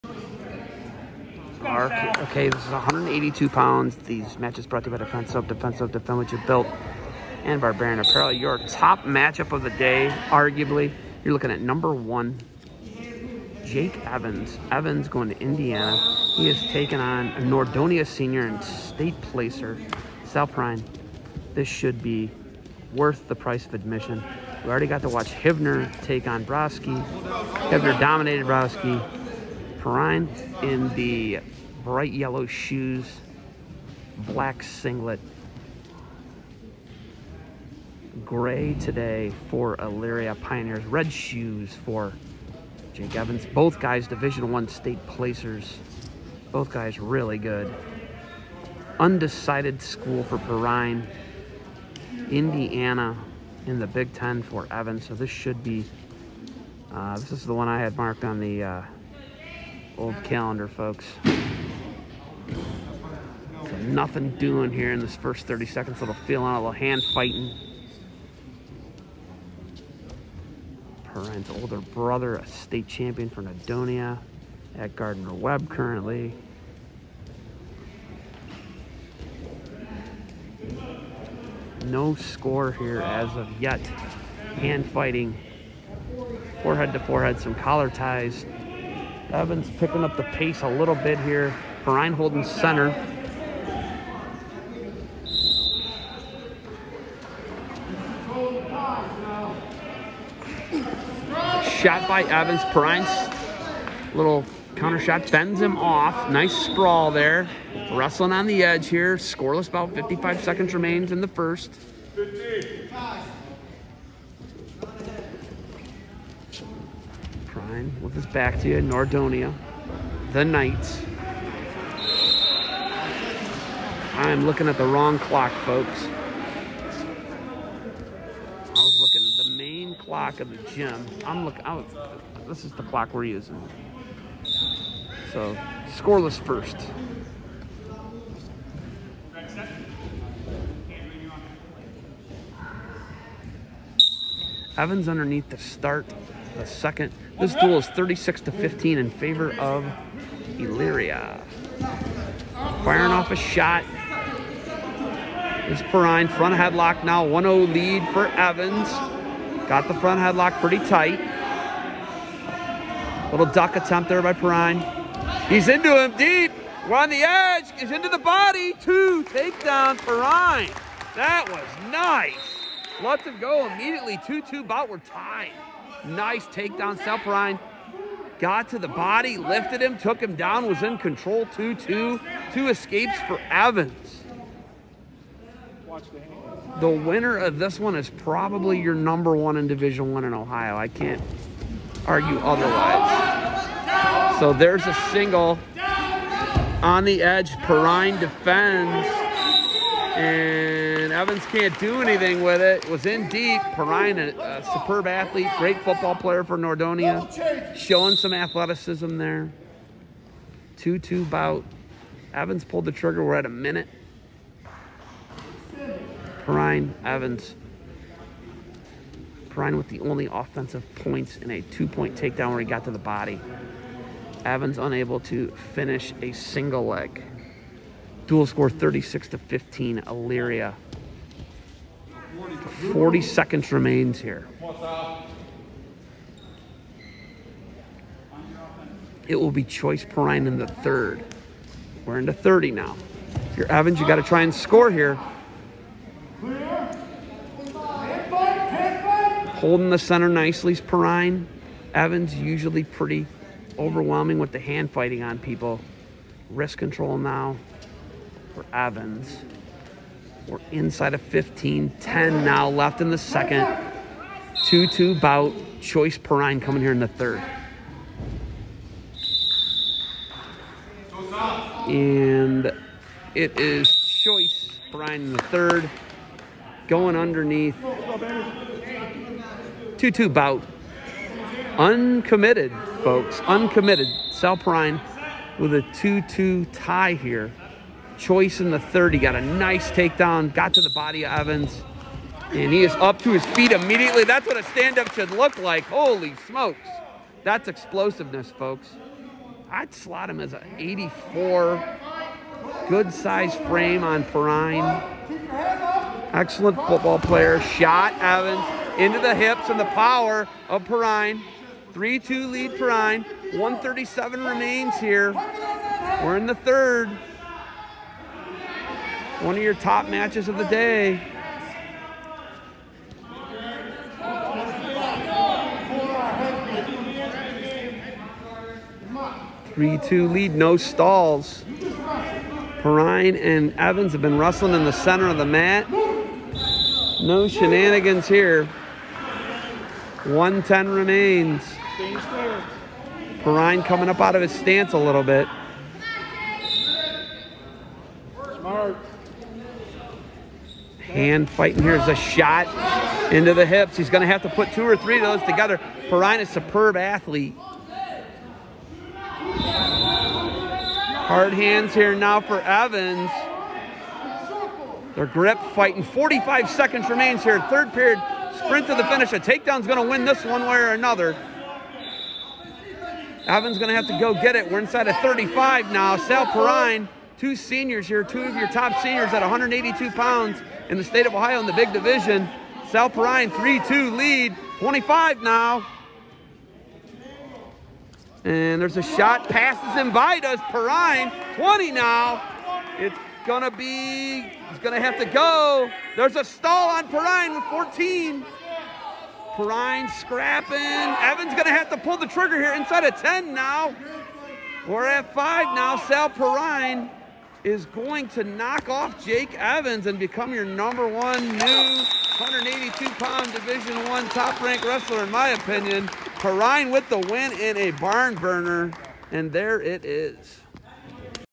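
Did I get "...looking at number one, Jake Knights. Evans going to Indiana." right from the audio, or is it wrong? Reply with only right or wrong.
wrong.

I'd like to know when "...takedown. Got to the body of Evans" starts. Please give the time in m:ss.
4:49.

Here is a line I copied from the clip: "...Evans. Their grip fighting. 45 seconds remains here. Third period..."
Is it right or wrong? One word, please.
right.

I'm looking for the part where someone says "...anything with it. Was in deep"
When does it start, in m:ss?
3:22.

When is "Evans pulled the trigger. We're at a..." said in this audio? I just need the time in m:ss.
3:32.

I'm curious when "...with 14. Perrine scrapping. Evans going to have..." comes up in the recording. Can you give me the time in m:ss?
6:37.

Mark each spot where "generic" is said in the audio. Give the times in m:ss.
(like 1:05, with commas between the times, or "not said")
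not said.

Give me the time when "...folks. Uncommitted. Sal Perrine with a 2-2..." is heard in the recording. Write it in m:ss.
4:43.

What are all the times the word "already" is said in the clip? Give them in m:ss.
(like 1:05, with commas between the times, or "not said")
0:24.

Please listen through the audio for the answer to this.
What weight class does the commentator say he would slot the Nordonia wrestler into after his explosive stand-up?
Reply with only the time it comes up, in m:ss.
5:00.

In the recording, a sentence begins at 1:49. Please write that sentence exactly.
Scoreless about 55 seconds remains in the first.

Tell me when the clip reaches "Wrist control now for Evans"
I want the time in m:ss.
4:16.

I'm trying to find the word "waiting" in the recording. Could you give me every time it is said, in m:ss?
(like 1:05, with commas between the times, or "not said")
not said.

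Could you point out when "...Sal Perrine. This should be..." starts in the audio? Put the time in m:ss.
0:20.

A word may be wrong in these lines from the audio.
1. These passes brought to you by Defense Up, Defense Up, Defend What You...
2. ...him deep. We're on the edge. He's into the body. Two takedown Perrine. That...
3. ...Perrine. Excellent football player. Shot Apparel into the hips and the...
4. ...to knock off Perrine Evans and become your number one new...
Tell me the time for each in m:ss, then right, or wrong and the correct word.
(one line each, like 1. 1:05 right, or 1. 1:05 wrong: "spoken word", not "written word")
1. 0:03 wrong: "matches", not "passes"
2. 2:45 right
3. 5:04 wrong: "Evans", not "Apparel"
4. 6:48 wrong: "Jake", not "Perrine".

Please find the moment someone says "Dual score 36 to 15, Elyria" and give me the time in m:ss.
3:48.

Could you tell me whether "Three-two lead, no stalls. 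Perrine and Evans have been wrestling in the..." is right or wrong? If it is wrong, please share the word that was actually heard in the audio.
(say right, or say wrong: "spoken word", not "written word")
right.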